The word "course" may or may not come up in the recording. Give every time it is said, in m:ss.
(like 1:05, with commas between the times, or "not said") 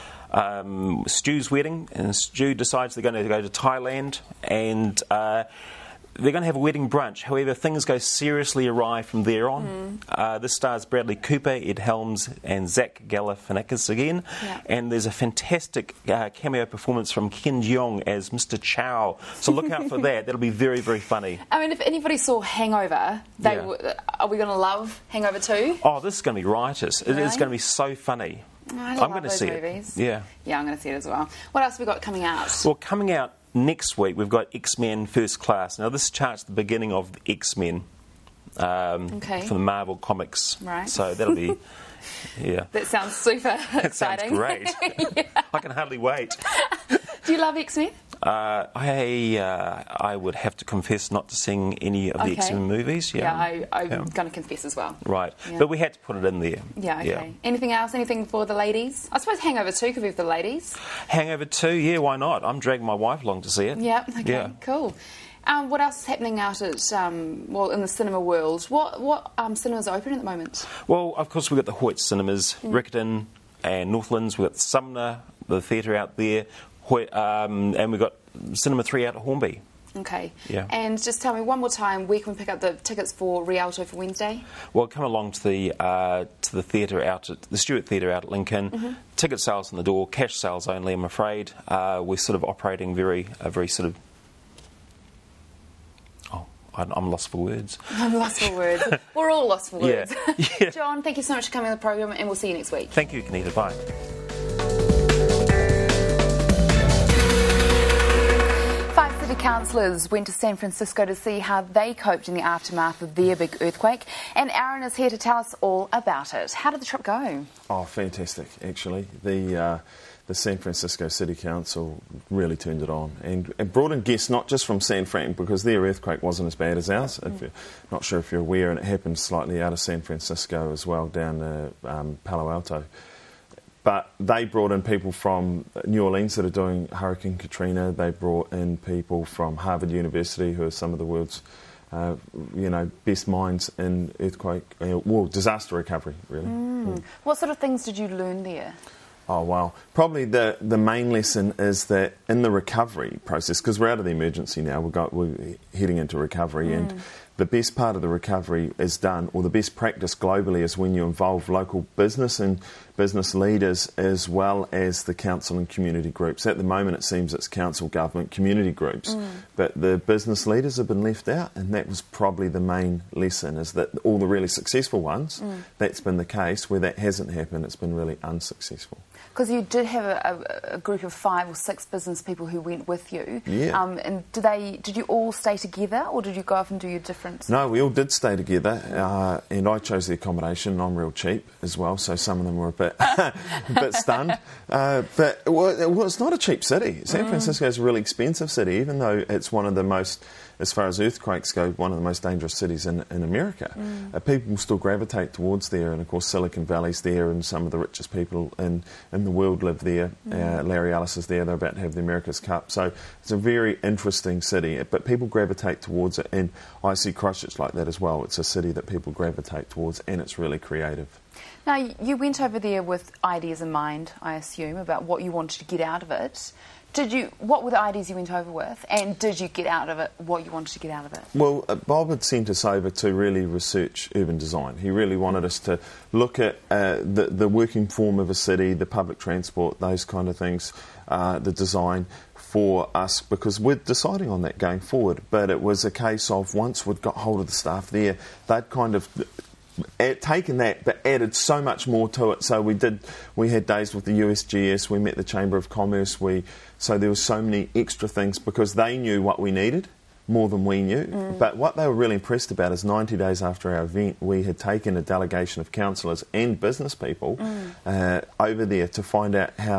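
1:11, 3:26.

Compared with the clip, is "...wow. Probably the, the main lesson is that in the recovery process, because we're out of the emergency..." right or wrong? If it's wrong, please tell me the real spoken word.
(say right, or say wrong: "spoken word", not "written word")
right.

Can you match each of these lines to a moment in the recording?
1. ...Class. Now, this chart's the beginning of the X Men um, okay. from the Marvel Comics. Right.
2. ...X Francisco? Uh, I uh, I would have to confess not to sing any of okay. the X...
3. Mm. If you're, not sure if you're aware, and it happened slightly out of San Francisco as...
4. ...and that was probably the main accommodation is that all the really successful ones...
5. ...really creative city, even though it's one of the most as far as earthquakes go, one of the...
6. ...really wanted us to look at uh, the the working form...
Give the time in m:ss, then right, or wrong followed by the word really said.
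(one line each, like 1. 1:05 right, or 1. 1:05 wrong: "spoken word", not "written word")
1. 0:35 right
2. 0:47 wrong: "Men", not "Francisco"
3. 2:07 right
4. 2:51 wrong: "lesson", not "accommodation"
5. 3:17 wrong: "expensive", not "creative"
6. 3:54 right.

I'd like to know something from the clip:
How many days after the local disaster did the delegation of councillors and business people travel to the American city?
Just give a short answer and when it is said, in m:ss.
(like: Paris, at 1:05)
90, at 4:22.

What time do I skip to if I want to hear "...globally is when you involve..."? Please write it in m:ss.
2:40.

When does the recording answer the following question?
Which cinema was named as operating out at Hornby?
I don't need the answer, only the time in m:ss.
1:18.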